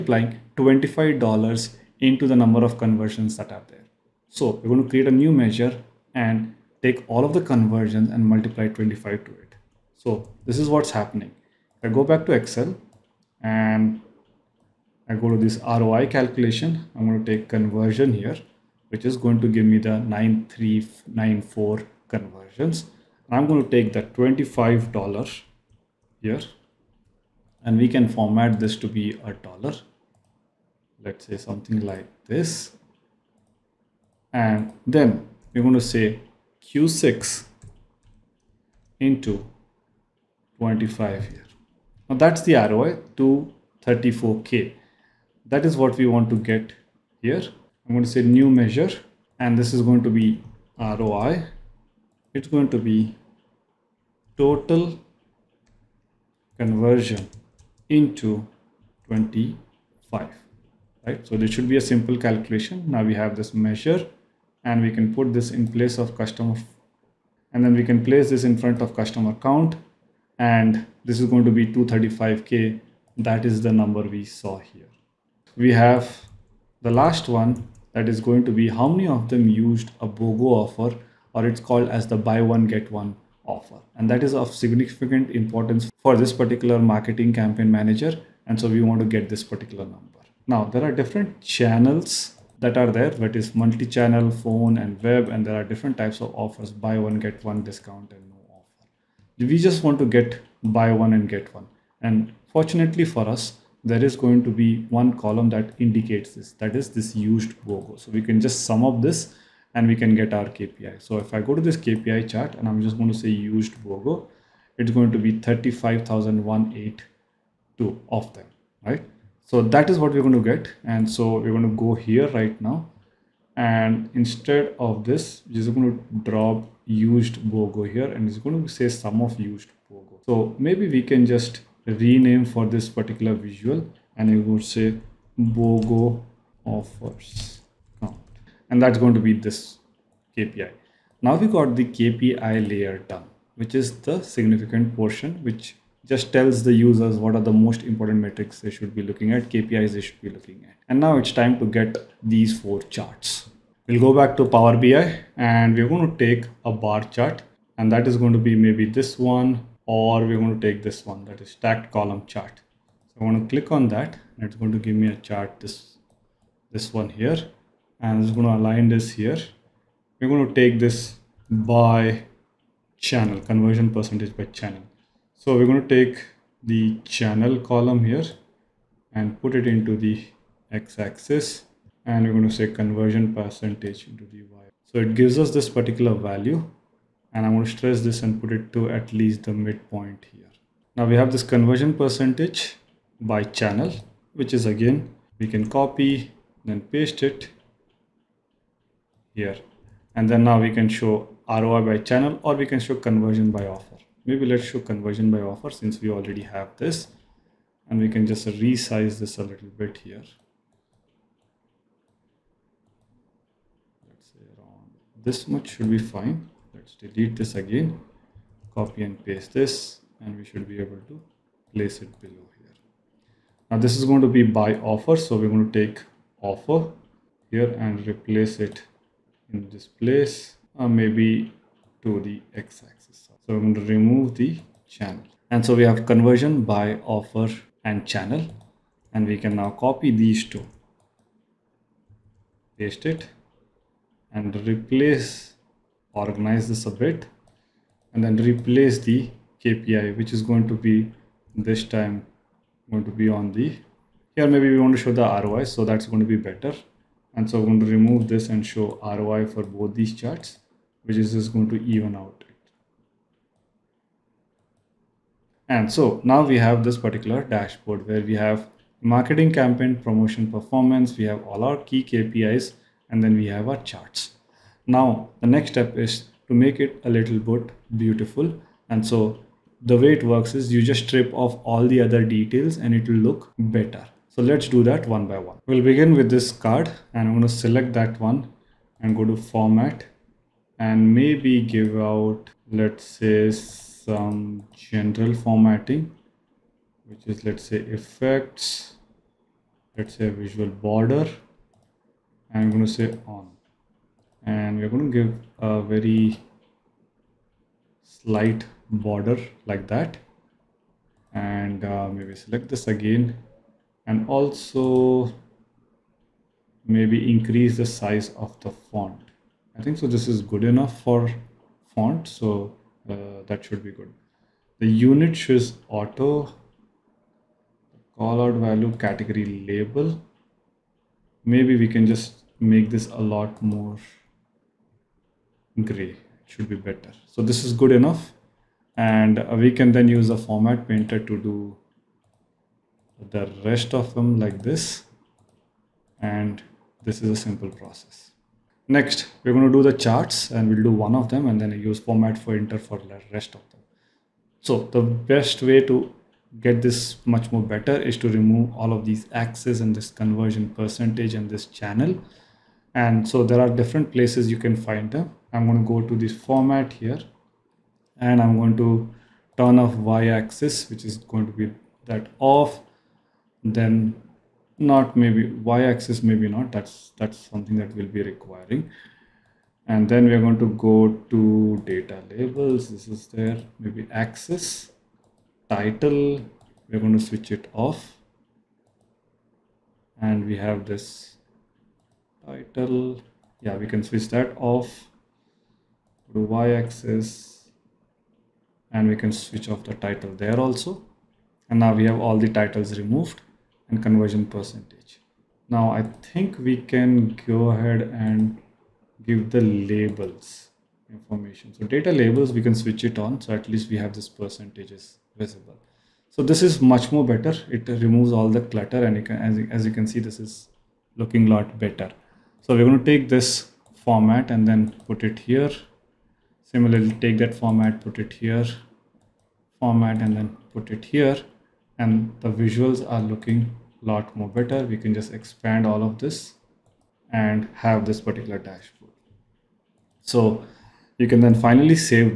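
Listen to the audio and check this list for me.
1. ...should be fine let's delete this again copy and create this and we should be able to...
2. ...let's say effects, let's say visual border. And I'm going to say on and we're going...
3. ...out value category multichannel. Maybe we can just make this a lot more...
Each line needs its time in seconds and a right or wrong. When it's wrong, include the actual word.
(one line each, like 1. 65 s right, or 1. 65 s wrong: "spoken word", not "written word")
1. 215 s wrong: "paste", not "create"
2. 297 s right
3. 328 s wrong: "label", not "multichannel".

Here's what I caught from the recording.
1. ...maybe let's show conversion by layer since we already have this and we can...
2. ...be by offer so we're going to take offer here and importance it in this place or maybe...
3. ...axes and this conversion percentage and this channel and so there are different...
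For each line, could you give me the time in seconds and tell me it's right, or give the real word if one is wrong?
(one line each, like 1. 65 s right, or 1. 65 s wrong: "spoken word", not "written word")
1. 204 s wrong: "offer", not "layer"
2. 224 s wrong: "replace", not "importance"
3. 359 s right.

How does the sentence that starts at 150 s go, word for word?
And now it's time to get these four charts.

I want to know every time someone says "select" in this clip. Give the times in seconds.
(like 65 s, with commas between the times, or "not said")
287 s, 312 s.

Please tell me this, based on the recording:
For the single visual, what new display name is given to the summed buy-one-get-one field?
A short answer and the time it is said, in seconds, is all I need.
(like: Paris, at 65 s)
BOGO offers, at 135 s.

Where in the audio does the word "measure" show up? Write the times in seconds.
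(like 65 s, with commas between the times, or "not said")
5 s, 48 s, 63 s.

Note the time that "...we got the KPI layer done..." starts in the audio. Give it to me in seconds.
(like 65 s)
141 s.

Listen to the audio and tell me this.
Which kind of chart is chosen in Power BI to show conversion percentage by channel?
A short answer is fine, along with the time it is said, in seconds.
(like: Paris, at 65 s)
stacked column chart, at 161 s.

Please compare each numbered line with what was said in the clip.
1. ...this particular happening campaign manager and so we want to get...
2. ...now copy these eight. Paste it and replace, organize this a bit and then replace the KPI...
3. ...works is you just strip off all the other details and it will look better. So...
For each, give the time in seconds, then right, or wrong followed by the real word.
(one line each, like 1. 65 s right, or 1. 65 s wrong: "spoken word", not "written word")
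1. 86 s wrong: "marketing", not "happening"
2. 239 s wrong: "two", not "eight"
3. 280 s right.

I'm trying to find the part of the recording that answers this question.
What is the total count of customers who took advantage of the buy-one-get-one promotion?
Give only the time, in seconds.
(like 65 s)
115 s.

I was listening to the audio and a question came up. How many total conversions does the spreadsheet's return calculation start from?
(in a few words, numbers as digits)
9394.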